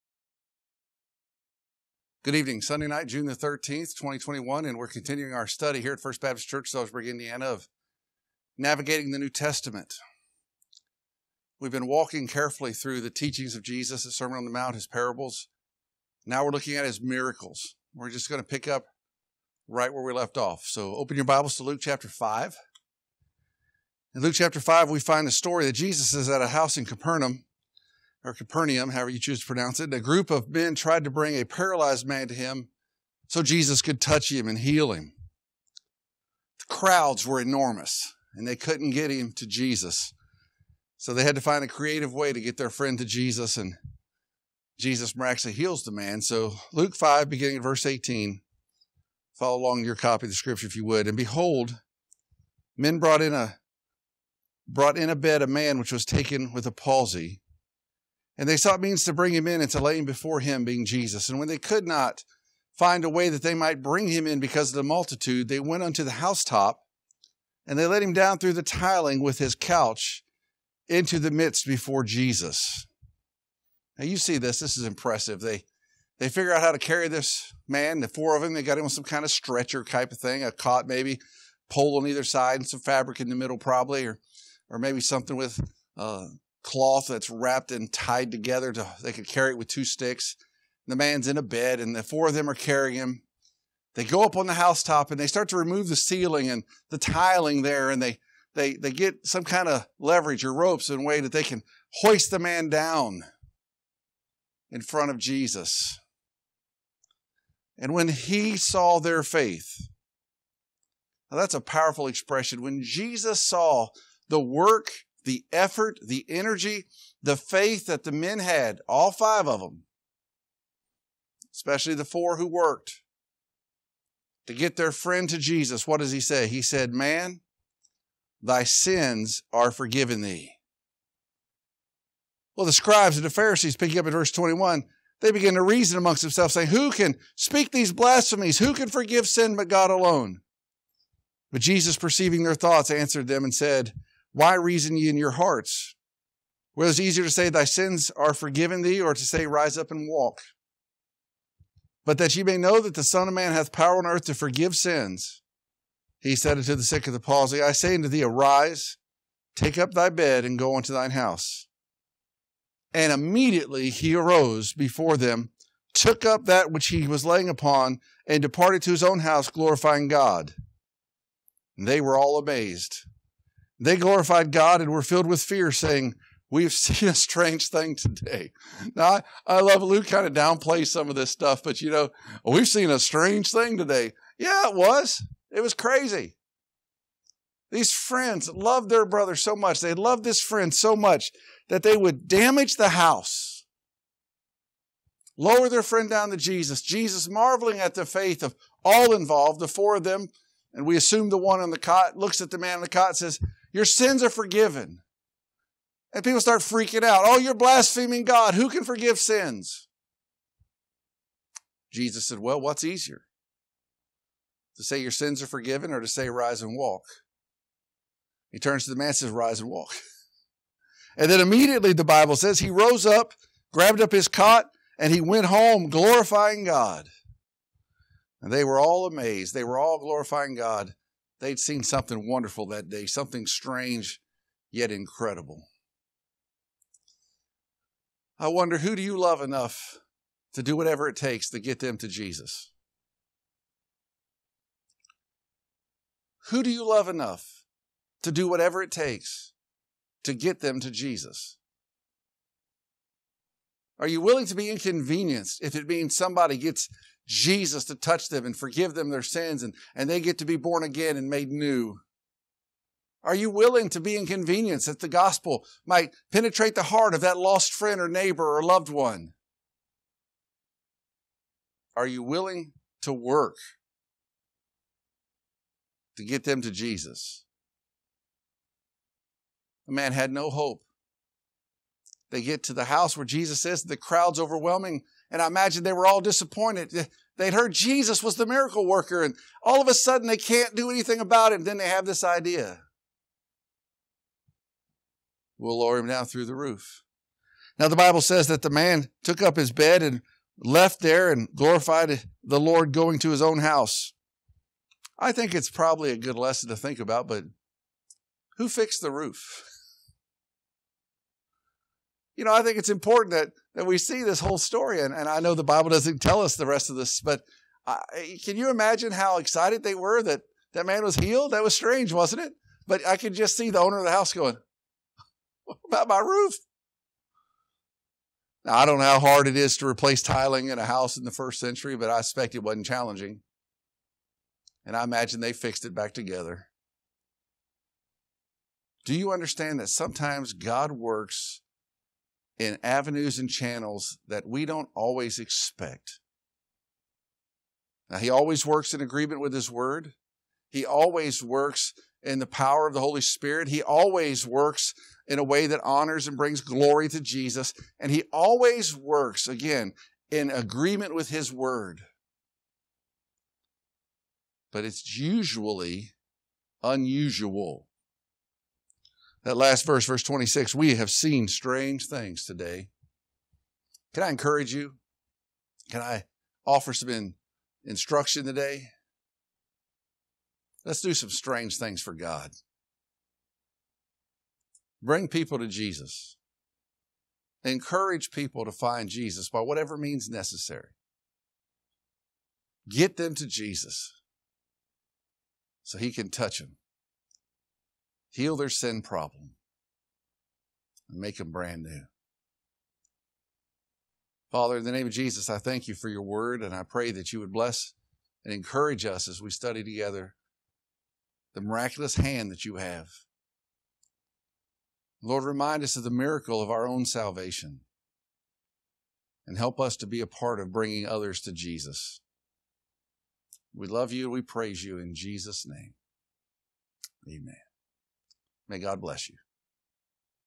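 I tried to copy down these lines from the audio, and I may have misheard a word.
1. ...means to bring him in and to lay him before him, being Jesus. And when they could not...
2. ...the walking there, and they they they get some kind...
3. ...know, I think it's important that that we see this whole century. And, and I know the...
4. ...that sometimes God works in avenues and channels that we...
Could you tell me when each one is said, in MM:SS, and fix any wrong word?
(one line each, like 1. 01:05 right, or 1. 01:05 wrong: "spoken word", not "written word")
1. 00:58 right
2. 01:36 wrong: "tiling", not "walking"
3. 05:12 wrong: "story", not "century"
4. 05:39 right.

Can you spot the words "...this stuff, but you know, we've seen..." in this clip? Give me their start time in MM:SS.
03:01.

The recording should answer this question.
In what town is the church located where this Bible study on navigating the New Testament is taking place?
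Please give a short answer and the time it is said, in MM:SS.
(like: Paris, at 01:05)
Sellersburg, Indiana, at 00:06.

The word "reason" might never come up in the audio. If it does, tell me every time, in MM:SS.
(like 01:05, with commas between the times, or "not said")
02:15, 02:24.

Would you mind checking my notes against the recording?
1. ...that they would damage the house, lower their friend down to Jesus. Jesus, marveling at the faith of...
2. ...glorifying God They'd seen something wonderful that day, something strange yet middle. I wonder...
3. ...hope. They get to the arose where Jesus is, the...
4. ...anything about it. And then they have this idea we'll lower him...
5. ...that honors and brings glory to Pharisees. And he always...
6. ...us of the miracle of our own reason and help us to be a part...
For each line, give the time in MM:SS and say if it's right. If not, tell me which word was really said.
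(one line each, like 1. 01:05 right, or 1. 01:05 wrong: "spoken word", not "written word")
1. 03:11 right
2. 03:49 wrong: "incredible", not "middle"
3. 04:40 wrong: "house", not "arose"
4. 04:50 right
5. 05:55 wrong: "Jesus", not "Pharisees"
6. 06:55 wrong: "salvation", not "reason".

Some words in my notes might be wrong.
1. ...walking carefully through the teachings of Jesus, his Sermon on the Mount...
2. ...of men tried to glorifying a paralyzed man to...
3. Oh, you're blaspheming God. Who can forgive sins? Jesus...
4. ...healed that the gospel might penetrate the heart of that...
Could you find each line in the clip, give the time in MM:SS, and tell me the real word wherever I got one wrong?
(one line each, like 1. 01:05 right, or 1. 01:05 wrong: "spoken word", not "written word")
1. 00:11 right
2. 00:30 wrong: "bring", not "glorifying"
3. 03:27 right
4. 04:24 wrong: "inconvenienced", not "healed".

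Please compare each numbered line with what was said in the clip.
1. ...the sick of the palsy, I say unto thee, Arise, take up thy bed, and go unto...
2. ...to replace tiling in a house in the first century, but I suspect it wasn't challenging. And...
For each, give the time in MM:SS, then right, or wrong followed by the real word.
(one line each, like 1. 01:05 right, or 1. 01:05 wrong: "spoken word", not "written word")
1. 02:36 right
2. 05:29 right.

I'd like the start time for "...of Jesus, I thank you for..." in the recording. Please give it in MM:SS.
06:45.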